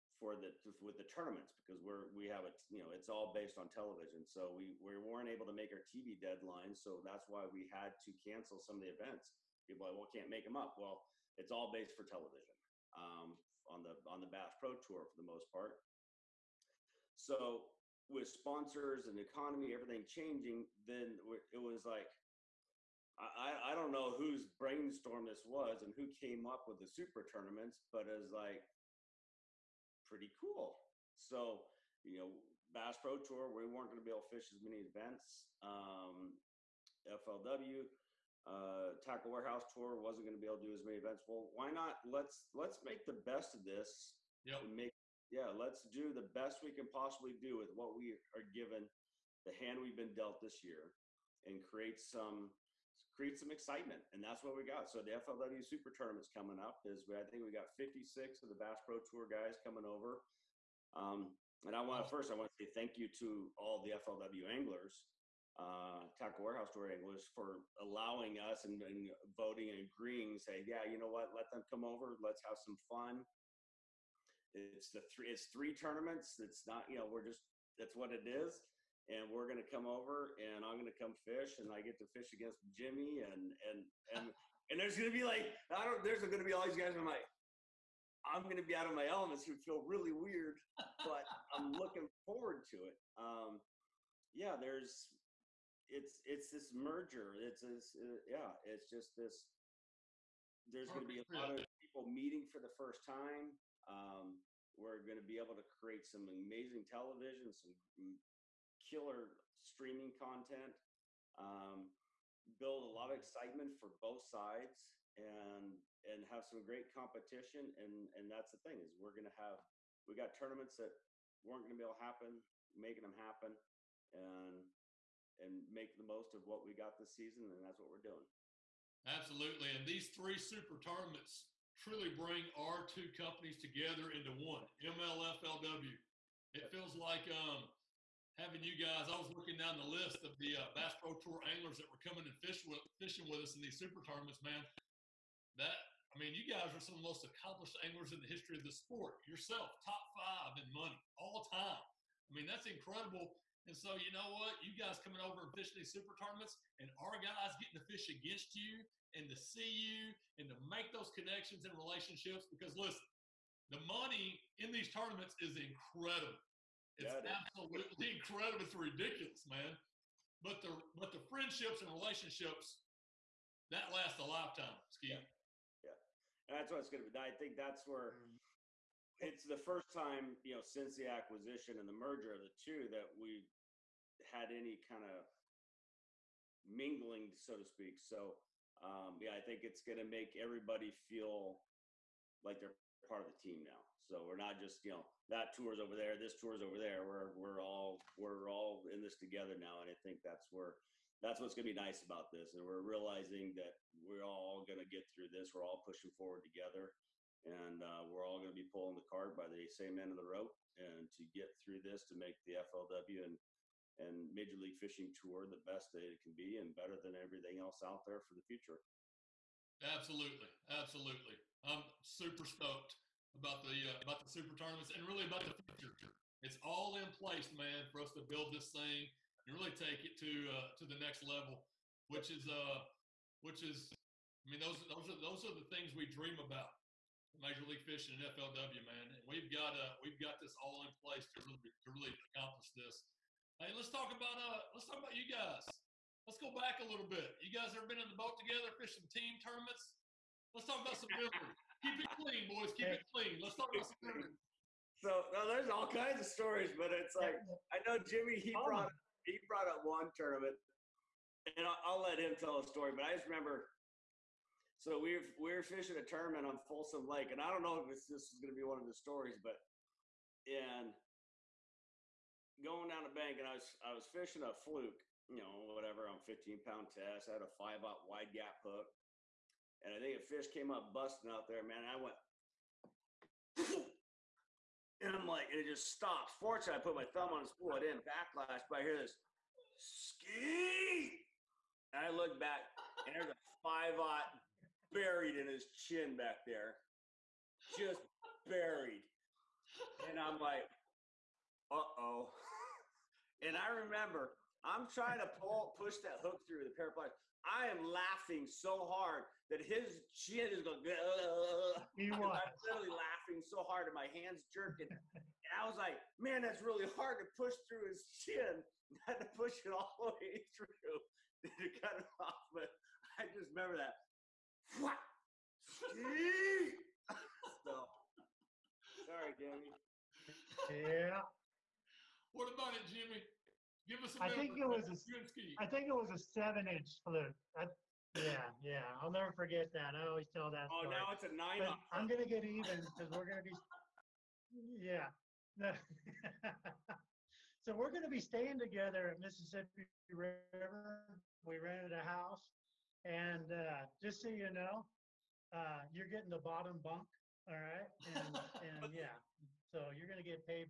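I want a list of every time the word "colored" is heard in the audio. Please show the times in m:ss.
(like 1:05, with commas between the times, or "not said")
not said.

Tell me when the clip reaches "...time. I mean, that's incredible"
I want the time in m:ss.
2:31.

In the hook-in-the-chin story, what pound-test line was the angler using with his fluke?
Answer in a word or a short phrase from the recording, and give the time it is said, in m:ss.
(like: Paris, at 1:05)
15, at 4:36.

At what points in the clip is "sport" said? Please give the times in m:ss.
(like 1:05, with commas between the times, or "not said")
2:28.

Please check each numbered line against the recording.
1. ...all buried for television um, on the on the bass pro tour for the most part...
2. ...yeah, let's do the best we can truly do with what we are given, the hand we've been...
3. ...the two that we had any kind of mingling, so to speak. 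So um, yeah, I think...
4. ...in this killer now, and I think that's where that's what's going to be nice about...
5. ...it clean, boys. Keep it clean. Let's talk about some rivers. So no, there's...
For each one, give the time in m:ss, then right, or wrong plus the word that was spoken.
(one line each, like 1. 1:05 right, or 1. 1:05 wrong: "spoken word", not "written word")
1. 0:11 wrong: "based", not "buried"
2. 0:45 wrong: "possibly", not "truly"
3. 3:02 right
4. 3:18 wrong: "together", not "killer"
5. 4:11 right.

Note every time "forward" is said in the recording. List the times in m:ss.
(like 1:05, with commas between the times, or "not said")
1:32, 3:26.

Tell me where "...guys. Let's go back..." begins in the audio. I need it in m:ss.
4:05.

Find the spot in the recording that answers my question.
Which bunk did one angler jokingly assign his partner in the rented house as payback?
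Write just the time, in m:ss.
5:56.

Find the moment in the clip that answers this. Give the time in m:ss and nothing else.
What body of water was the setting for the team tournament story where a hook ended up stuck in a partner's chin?
4:26.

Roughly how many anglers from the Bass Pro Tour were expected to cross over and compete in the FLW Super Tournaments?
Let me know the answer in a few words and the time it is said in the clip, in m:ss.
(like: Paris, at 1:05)
56, at 0:57.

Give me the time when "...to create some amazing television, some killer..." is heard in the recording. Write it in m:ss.
1:45.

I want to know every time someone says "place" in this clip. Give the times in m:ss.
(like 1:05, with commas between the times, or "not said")
3:47, 4:01.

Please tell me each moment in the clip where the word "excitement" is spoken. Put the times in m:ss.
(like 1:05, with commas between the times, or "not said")
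0:53, 1:53.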